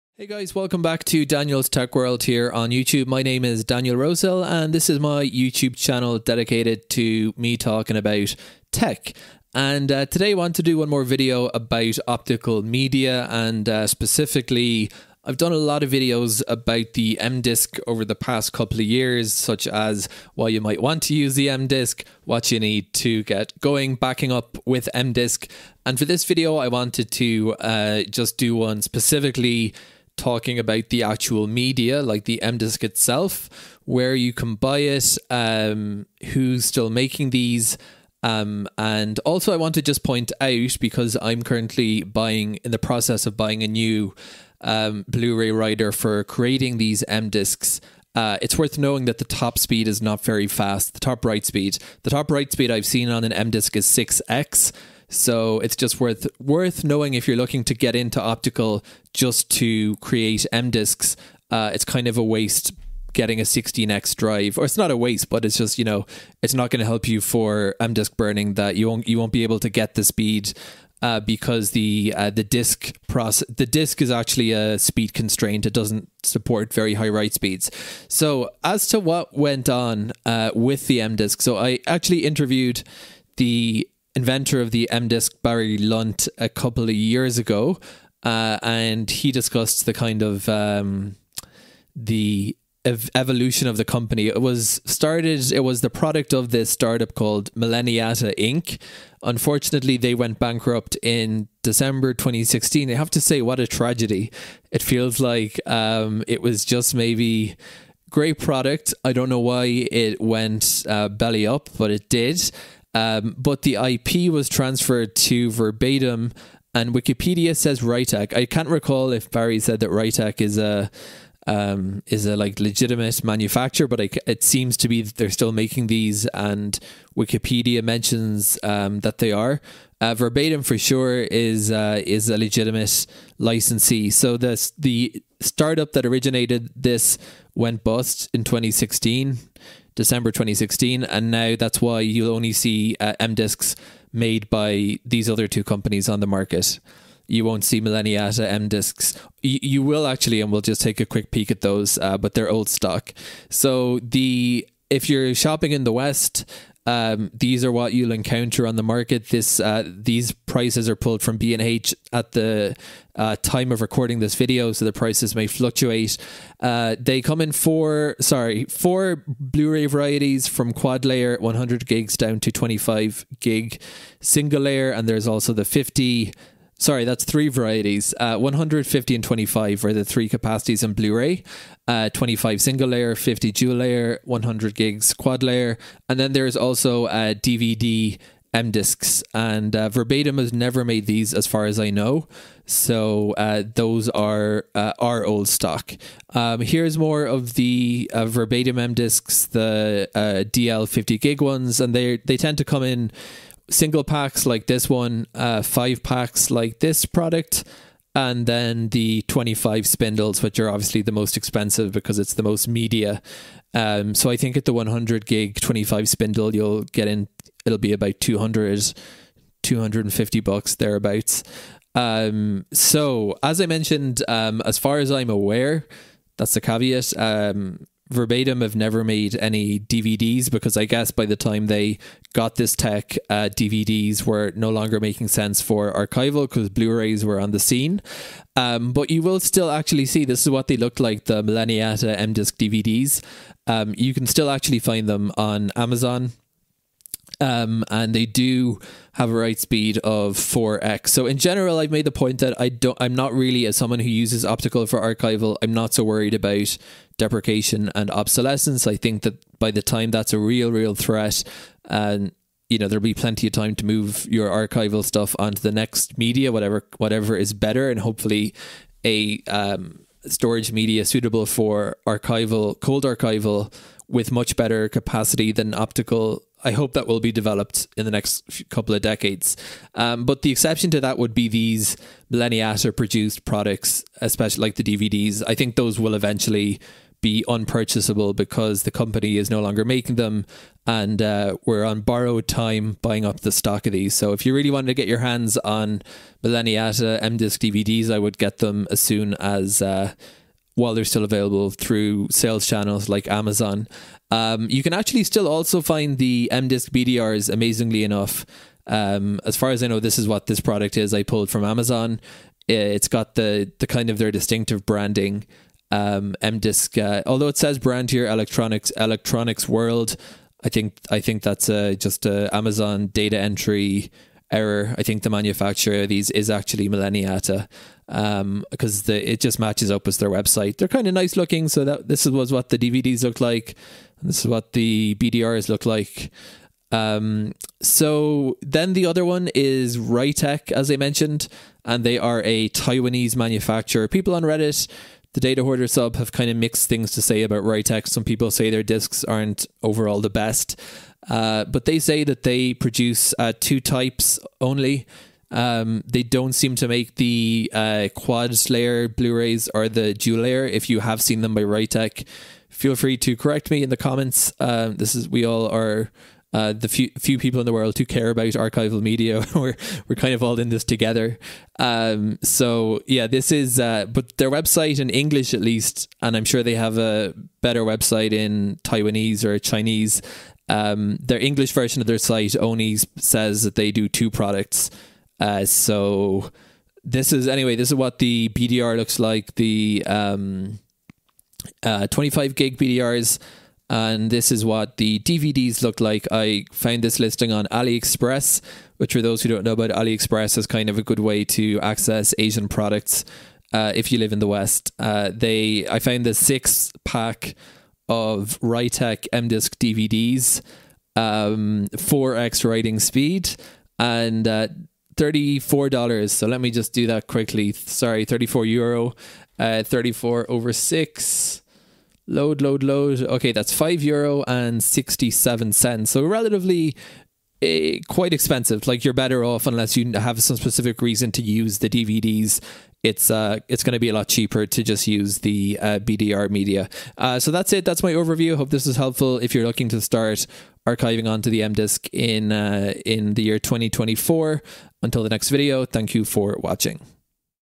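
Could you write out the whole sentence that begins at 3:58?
Um, but you will still actually see this is what they looked like the Millenniata M Disc DVDs.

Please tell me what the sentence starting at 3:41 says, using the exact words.
Um, so as I mentioned, um, as far as I'm aware, that's the caveat.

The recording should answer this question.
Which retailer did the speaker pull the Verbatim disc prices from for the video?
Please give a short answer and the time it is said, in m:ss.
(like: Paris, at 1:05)
B and H, at 2:41.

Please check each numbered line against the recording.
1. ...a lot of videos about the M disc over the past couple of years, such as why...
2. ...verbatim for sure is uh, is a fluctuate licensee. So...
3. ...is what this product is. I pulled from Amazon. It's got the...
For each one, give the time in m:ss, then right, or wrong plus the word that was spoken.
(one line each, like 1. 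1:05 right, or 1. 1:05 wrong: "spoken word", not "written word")
1. 0:15 right
2. 2:10 wrong: "legitimate", not "fluctuate"
3. 5:10 right.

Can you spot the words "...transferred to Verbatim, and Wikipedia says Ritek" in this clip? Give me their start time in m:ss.
1:54.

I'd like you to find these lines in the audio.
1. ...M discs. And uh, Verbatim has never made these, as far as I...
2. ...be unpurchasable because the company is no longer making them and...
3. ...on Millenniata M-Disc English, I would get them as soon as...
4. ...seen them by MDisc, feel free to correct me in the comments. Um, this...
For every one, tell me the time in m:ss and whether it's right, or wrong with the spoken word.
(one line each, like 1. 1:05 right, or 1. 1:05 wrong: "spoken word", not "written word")
1. 3:08 right
2. 4:47 right
3. 4:55 wrong: "DVDs", not "English"
4. 6:01 wrong: "Ritek", not "MDisc".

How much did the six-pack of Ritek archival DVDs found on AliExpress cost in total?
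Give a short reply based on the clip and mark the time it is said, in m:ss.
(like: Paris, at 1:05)
34 euro, at 6:58.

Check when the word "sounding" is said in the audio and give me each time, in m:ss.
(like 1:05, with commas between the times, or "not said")
not said.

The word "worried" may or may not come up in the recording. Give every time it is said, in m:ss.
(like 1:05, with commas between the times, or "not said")
4:16.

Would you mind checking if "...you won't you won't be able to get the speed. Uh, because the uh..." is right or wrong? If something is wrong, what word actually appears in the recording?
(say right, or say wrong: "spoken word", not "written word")
right.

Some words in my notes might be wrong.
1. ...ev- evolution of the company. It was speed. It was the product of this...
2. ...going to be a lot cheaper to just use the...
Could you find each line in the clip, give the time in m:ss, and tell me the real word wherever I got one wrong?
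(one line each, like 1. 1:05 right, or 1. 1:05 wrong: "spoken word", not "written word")
1. 1:32 wrong: "started", not "speed"
2. 7:13 right.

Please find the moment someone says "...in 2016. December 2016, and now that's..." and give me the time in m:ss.
2:18.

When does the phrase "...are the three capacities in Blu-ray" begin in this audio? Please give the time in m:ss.
2:59.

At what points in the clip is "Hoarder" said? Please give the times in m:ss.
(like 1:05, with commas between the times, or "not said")
5:45.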